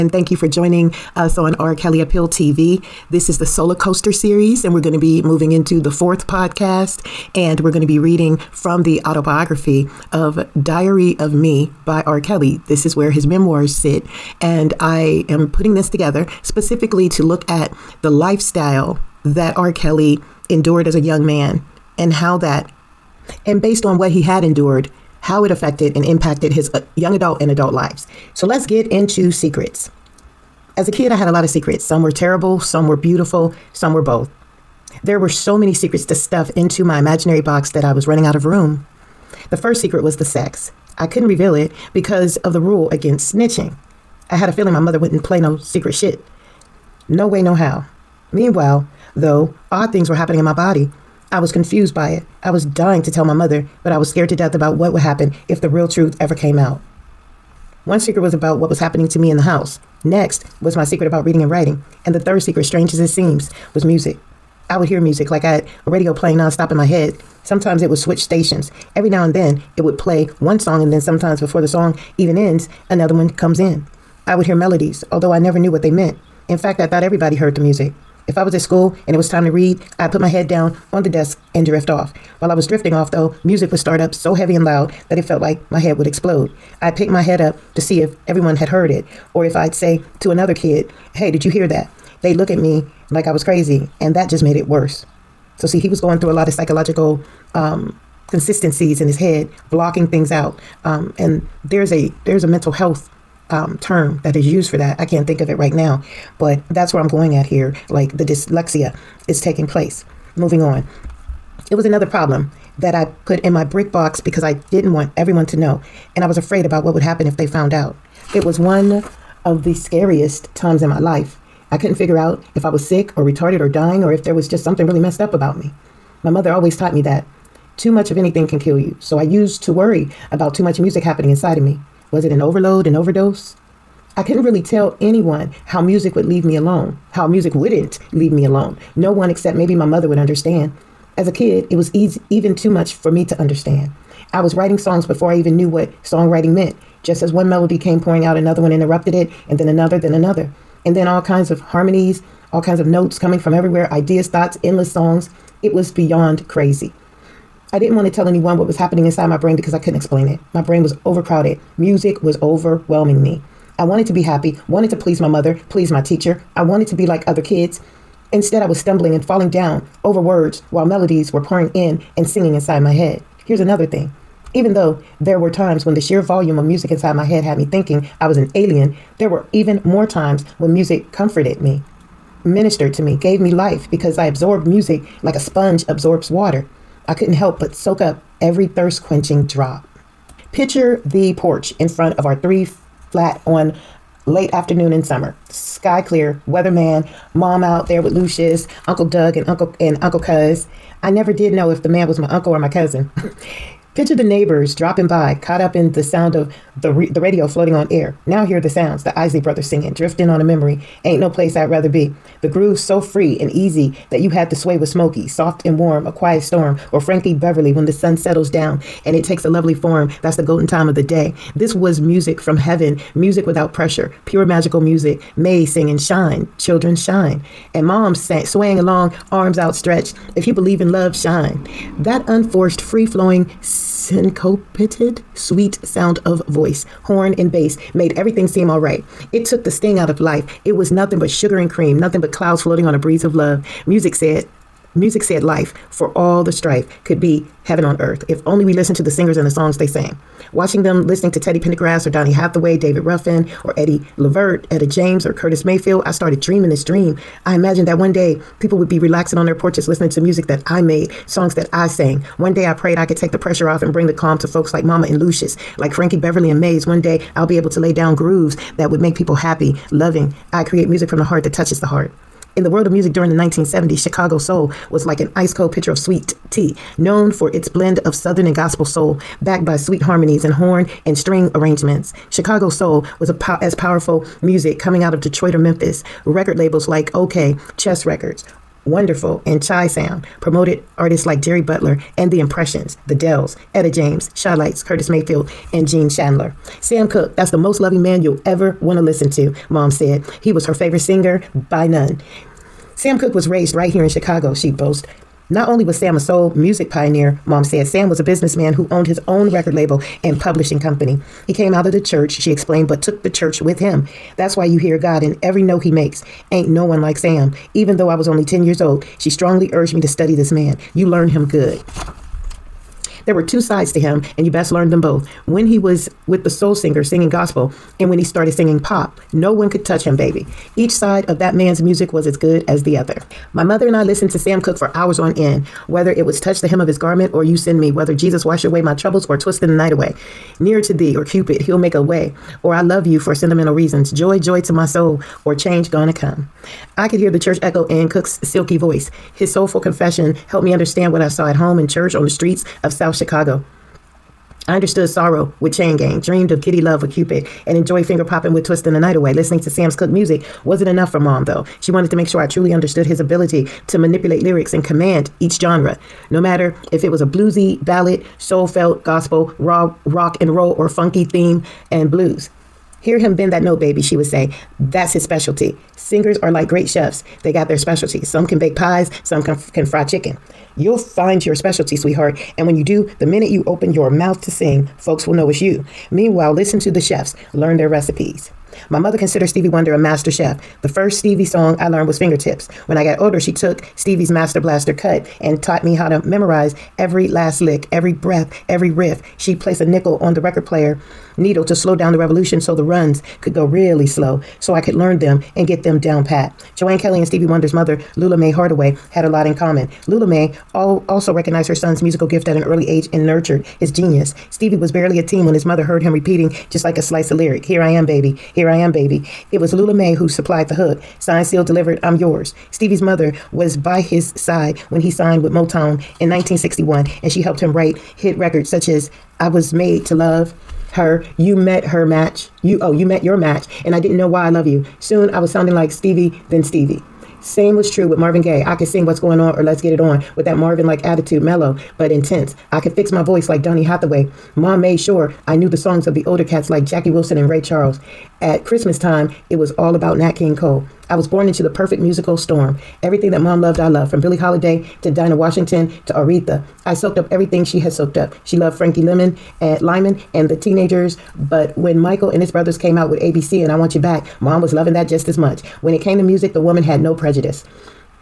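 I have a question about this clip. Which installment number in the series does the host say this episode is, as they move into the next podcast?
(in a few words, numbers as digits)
4.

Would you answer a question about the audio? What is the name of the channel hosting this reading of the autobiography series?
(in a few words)
R. Kelly Appeal TV.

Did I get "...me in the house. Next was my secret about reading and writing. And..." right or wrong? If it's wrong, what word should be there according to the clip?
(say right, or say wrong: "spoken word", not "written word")
right.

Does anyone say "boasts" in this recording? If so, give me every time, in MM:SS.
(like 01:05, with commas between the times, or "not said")
05:04.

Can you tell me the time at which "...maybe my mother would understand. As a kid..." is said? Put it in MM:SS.
02:19.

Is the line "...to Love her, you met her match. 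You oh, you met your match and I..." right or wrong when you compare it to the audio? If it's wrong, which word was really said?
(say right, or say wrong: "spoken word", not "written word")
right.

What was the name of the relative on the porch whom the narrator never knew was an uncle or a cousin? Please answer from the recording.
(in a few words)
Uncle Cuz.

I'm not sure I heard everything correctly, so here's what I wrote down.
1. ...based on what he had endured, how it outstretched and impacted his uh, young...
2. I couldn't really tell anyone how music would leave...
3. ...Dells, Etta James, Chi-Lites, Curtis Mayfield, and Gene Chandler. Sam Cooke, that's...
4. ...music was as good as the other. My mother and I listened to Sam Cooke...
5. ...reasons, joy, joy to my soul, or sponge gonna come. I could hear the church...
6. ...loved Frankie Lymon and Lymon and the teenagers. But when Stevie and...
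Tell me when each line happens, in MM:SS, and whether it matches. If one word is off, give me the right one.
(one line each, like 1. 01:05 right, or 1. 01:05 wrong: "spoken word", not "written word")
1. 00:23 wrong: "affected", not "outstretched"
2. 02:14 right
3. 04:53 right
4. 05:31 right
5. 05:43 wrong: "change", not "sponge"
6. 07:38 wrong: "Michael", not "Stevie".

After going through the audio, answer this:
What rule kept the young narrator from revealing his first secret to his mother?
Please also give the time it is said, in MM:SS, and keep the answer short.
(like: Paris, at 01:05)
The rule against snitching, at 00:43.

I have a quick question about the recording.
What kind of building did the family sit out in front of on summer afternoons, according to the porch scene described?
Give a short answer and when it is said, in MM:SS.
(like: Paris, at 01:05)
Three flat, at 03:12.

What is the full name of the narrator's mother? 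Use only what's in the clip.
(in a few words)
Joanne Kelly.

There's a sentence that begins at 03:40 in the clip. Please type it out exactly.
That's the golden time of the day.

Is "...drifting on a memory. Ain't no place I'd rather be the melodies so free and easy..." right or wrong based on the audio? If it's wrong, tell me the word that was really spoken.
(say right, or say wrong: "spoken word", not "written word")
wrong: "grooves", not "melodies".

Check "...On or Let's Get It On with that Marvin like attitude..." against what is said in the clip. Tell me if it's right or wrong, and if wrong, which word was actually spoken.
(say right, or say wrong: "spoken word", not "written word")
right.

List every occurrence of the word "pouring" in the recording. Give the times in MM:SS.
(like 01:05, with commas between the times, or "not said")
02:27, 02:51.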